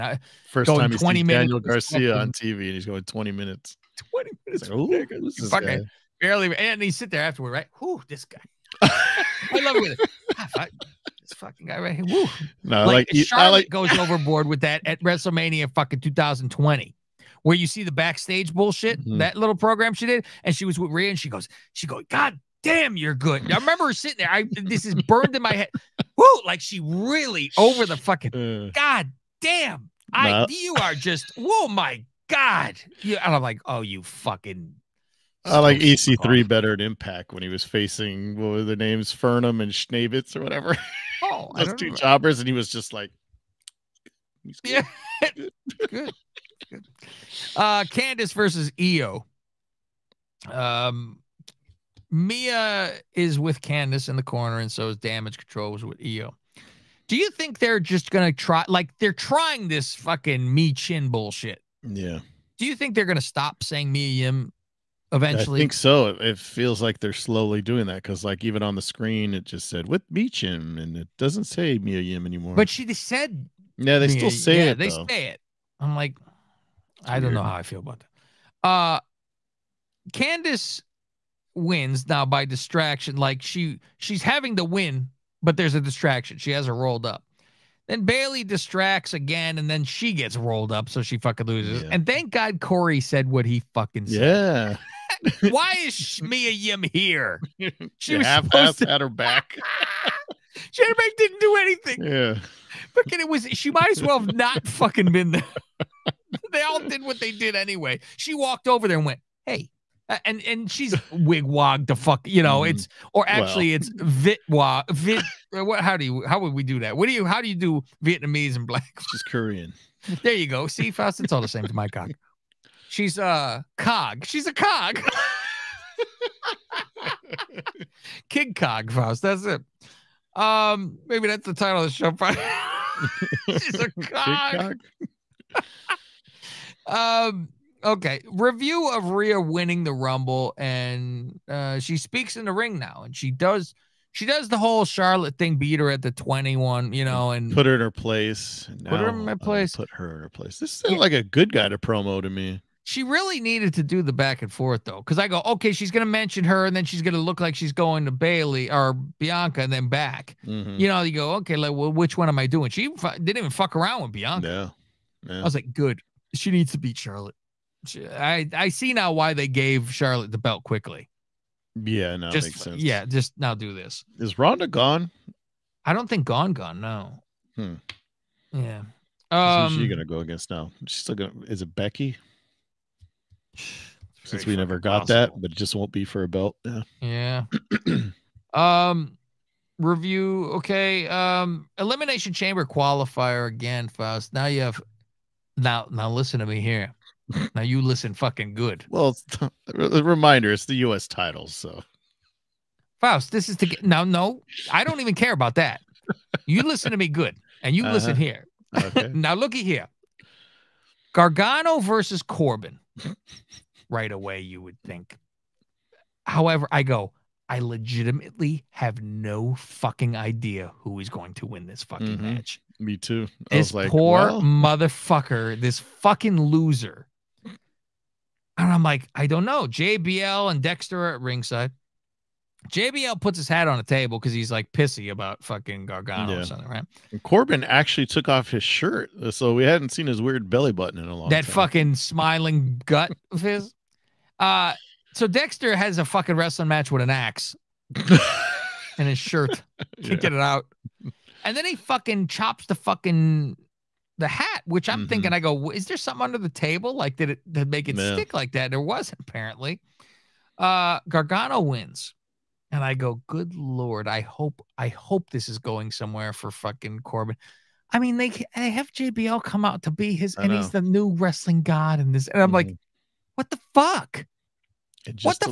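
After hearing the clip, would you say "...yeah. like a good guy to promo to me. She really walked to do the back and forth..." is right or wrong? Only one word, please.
wrong.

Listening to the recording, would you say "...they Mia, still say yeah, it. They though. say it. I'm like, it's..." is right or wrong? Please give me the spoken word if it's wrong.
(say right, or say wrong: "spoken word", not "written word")
right.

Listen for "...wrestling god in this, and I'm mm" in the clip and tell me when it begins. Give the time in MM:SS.
04:31.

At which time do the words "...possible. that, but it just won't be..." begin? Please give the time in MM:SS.
03:05.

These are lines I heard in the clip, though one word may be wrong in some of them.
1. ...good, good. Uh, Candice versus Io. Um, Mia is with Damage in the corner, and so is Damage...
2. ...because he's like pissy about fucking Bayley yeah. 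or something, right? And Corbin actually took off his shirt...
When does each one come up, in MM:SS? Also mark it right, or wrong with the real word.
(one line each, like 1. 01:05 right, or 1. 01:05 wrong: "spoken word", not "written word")
1. 00:45 wrong: "Candice", not "Damage"
2. 03:54 wrong: "Gargano", not "Bayley".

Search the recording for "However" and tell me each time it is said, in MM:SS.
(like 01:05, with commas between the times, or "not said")
03:36.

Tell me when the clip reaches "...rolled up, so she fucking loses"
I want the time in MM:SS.
01:30.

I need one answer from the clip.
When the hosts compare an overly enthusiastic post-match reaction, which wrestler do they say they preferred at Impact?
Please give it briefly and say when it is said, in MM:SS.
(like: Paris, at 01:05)
EC3, at 00:35.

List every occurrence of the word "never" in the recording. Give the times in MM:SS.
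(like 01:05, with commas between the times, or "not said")
03:04.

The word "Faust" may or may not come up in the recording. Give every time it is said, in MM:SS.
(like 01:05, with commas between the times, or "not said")
02:00, 02:08, 03:13, 03:23.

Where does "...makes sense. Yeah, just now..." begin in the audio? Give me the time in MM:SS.
02:52.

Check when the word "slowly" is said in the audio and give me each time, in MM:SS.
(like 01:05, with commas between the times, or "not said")
01:07.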